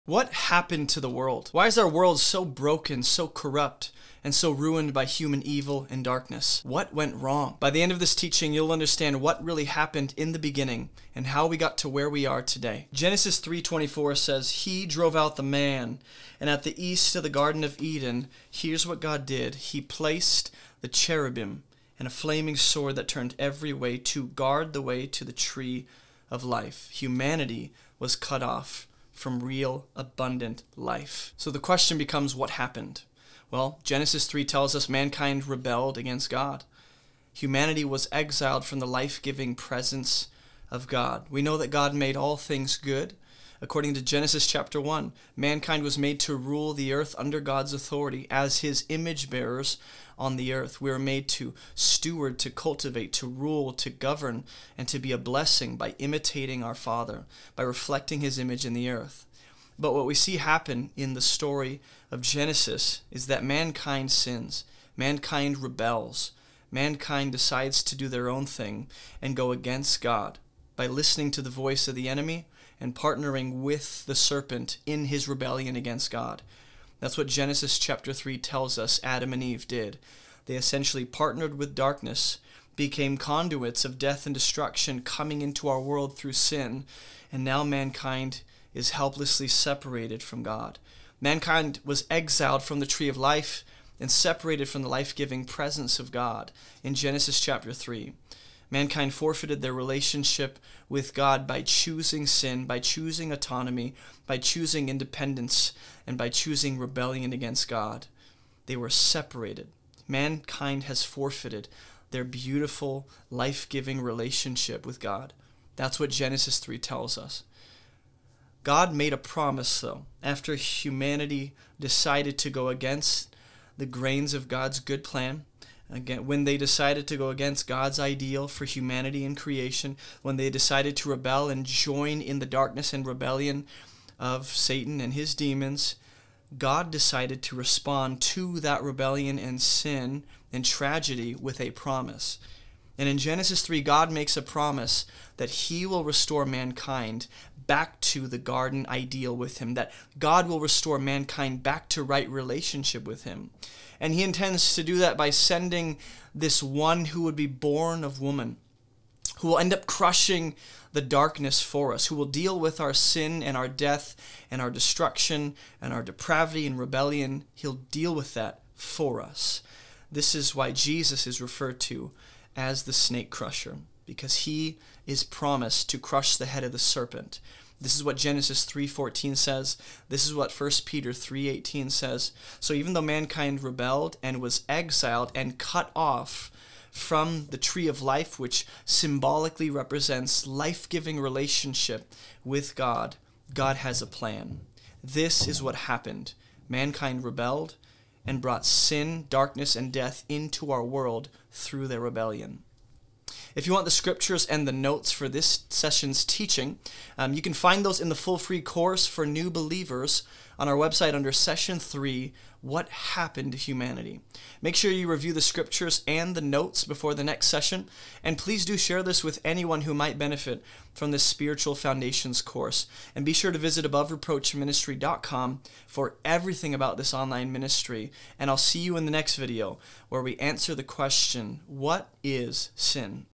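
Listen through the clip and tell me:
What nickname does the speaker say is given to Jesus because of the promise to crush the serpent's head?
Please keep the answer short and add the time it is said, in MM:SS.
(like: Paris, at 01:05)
the snake crusher, at 02:52.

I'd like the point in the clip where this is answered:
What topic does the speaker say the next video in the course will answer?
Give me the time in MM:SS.
03:51.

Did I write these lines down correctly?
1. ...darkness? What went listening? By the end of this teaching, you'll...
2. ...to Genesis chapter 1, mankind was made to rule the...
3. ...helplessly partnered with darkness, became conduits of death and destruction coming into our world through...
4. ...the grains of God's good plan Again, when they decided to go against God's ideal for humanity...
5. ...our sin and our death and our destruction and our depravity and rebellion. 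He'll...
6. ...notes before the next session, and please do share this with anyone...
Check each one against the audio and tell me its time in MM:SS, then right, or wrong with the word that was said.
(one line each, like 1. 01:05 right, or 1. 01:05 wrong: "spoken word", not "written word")
1. 00:06 wrong: "wrong", not "listening"
2. 00:43 right
3. 01:20 wrong: "essentially", not "helplessly"
4. 02:03 right
5. 02:42 right
6. 03:36 right.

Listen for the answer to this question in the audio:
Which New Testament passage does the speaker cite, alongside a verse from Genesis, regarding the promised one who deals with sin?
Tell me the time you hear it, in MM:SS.
03:00.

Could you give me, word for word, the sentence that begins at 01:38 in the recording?
Mankind forfeited their relationship with God by choosing sin, by choosing autonomy, by choosing independence, and by choosing rebellion against God.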